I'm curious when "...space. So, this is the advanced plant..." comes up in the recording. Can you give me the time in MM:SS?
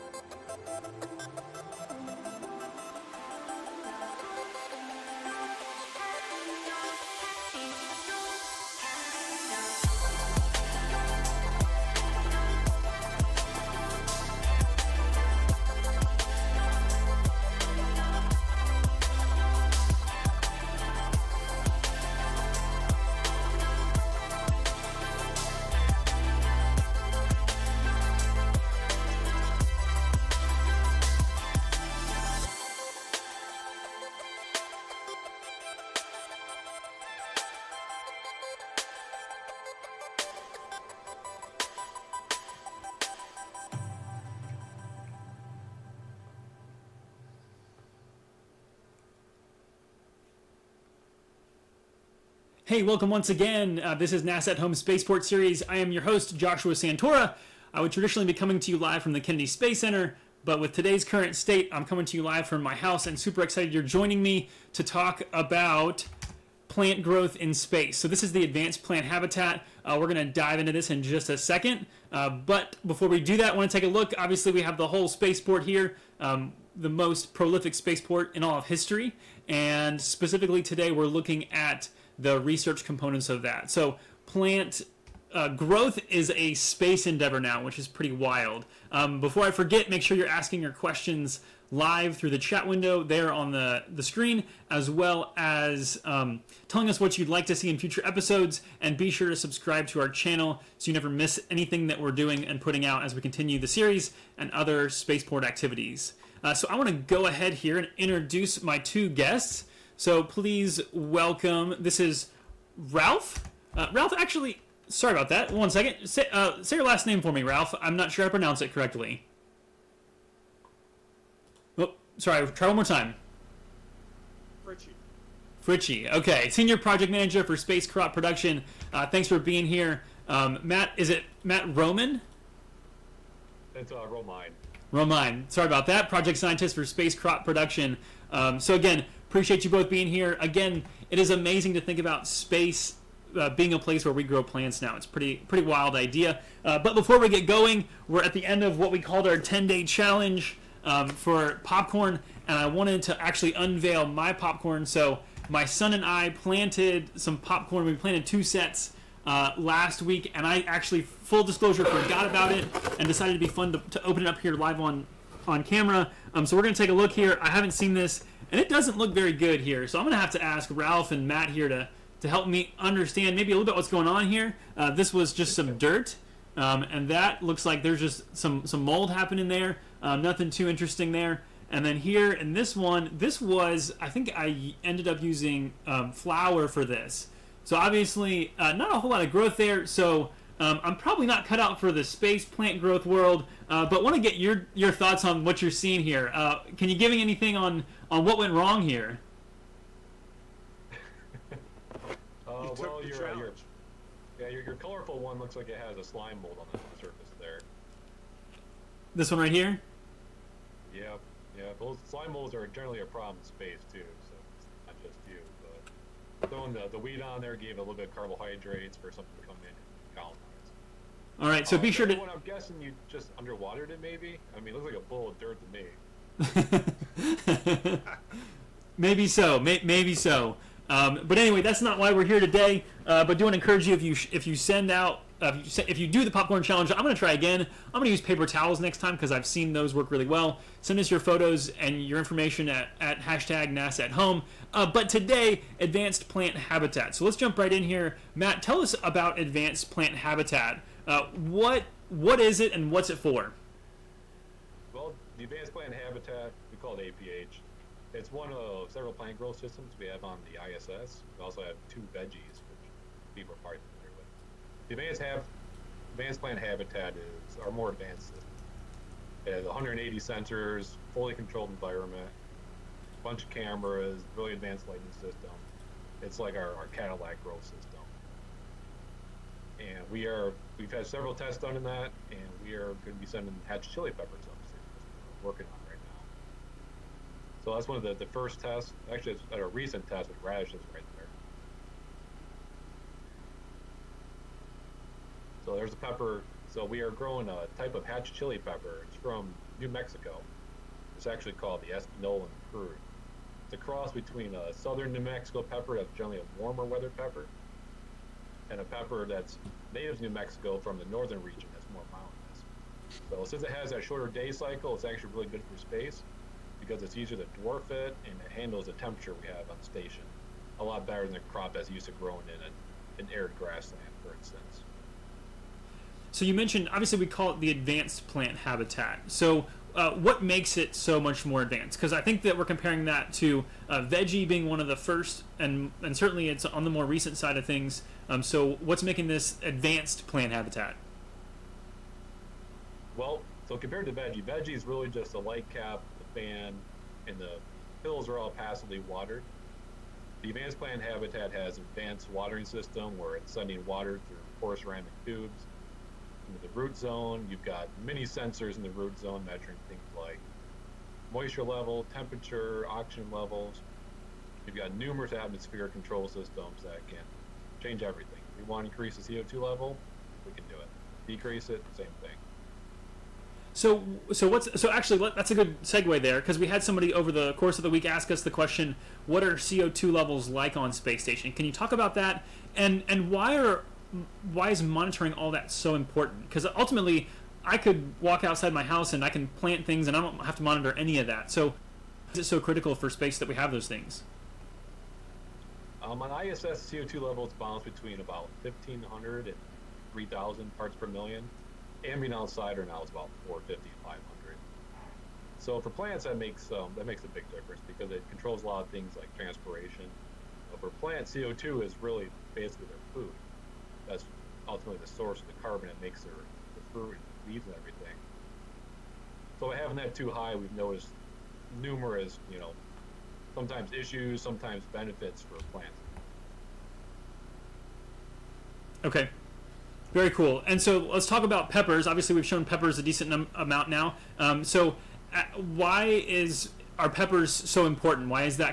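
01:07.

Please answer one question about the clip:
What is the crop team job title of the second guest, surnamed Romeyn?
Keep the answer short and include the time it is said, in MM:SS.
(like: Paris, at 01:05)
Project scientist, at 02:16.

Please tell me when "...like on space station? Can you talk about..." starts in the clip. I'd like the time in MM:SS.
06:20.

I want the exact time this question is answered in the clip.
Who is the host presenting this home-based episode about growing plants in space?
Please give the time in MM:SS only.
00:56.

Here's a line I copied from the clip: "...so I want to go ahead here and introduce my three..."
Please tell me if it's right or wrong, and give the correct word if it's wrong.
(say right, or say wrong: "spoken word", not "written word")
wrong: "two", not "three".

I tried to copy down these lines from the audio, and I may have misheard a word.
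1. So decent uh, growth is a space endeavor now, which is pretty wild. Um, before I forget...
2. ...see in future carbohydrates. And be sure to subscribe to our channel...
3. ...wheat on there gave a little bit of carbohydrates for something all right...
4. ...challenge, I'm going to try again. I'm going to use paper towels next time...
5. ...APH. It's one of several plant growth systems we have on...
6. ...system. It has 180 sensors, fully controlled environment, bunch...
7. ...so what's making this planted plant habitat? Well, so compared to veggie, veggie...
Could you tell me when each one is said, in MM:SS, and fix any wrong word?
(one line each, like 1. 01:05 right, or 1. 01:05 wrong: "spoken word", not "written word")
1. 01:23 wrong: "plant", not "decent"
2. 01:37 wrong: "episodes", not "carbohydrates"
3. 03:36 right
4. 03:56 right
5. 04:17 right
6. 04:28 right
7. 05:38 wrong: "advanced", not "planted".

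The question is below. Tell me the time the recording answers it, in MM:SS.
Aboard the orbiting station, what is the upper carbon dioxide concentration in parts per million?
06:40.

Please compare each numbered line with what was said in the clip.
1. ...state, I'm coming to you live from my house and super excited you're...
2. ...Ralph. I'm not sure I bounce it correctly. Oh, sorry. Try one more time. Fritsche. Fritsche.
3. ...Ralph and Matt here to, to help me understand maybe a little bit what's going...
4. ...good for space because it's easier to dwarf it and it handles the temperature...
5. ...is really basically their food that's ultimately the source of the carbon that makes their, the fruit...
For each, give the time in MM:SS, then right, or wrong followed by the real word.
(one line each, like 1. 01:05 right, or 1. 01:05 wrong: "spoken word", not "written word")
1. 01:01 right
2. 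01:57 wrong: "pronounce", not "bounce"
3. 02:50 right
4. 05:15 right
5. 06:51 right.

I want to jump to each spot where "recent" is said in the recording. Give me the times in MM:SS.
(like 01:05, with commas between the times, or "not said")
04:49, 05:37.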